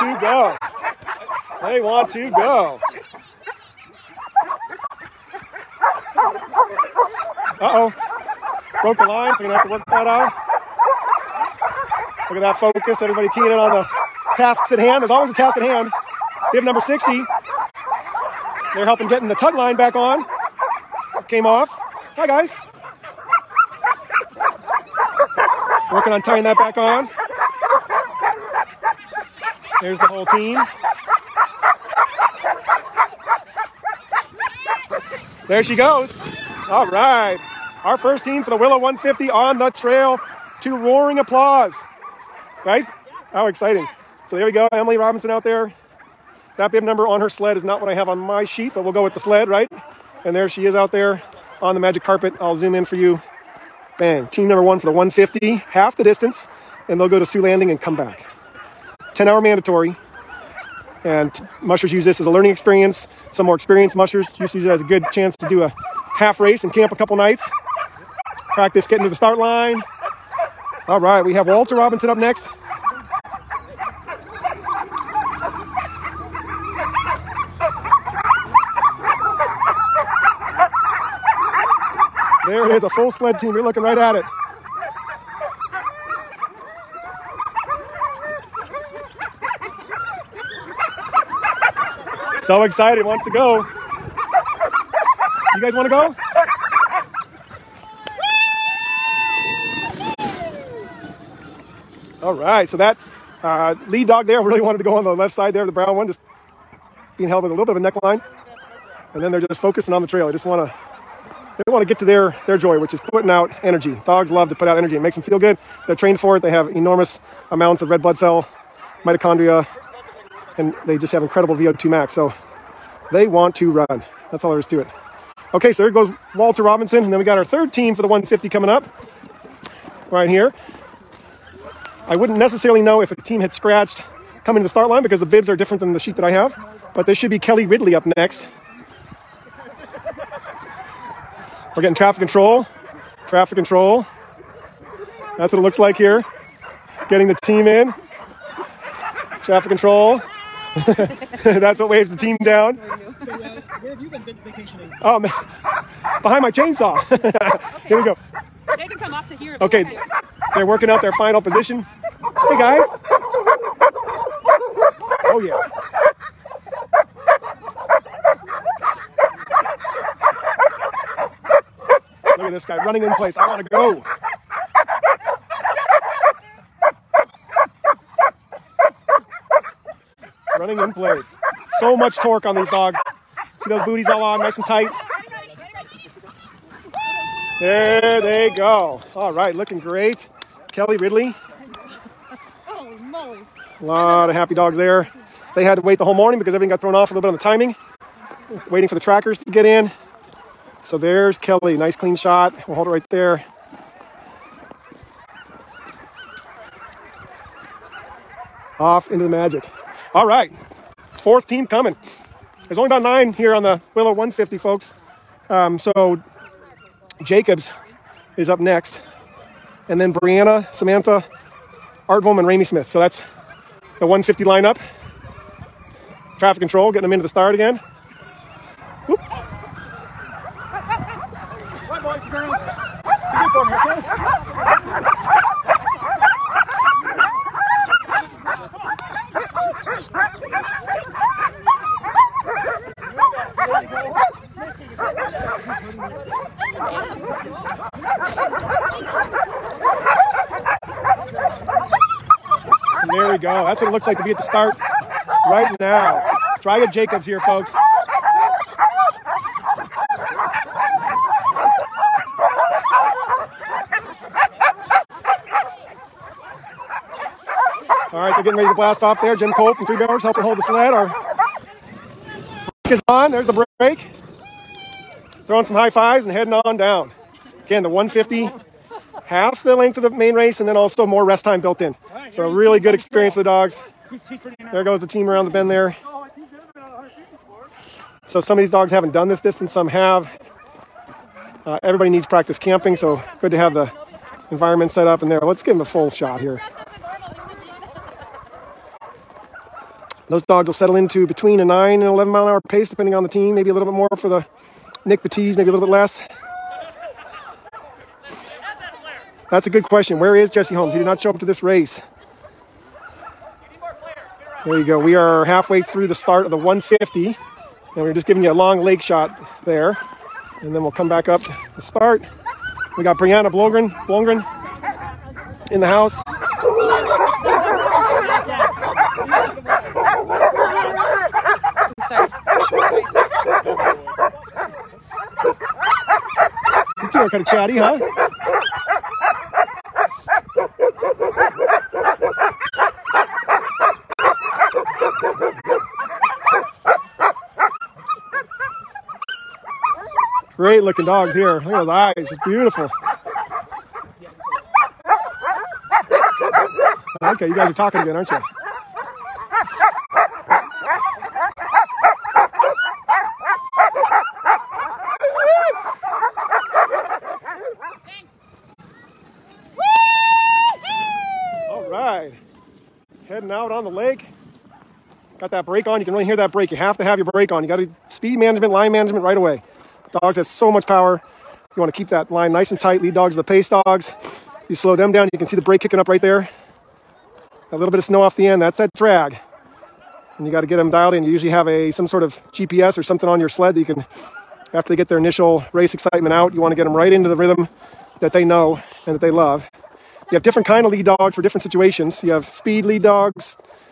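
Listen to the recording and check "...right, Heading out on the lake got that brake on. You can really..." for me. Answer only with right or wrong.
right.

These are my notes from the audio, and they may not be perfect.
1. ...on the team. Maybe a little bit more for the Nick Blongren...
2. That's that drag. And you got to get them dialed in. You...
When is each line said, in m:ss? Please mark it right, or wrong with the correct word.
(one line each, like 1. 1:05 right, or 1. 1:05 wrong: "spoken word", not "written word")
1. 5:03 wrong: "Batiste", not "Blongren"
2. 6:28 right.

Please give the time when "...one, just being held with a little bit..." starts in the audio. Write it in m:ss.
1:45.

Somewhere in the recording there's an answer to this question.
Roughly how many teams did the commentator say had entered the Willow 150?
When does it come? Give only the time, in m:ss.
3:33.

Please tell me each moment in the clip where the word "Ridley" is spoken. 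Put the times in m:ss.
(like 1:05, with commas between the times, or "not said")
2:17, 3:10.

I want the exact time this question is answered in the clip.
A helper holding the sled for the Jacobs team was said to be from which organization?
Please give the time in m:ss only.
4:29.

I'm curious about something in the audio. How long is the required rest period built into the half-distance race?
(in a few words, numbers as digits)
10 hours.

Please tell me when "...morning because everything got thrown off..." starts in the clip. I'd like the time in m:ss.
3:16.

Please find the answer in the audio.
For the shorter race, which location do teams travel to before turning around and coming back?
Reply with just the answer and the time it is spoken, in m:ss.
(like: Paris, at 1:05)
Su Landing, at 0:57.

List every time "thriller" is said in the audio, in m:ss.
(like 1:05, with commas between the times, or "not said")
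not said.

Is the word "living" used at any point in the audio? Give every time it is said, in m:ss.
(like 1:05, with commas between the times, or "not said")
not said.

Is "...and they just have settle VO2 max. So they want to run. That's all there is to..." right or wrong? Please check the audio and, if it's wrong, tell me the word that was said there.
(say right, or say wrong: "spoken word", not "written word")
wrong: "incredible", not "settle".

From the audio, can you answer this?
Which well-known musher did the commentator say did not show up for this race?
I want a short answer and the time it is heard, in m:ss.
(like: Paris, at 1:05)
Jesse Holmes, at 5:10.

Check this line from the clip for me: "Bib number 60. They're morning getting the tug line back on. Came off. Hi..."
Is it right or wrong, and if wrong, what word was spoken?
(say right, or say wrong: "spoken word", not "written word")
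wrong: "helping", not "morning".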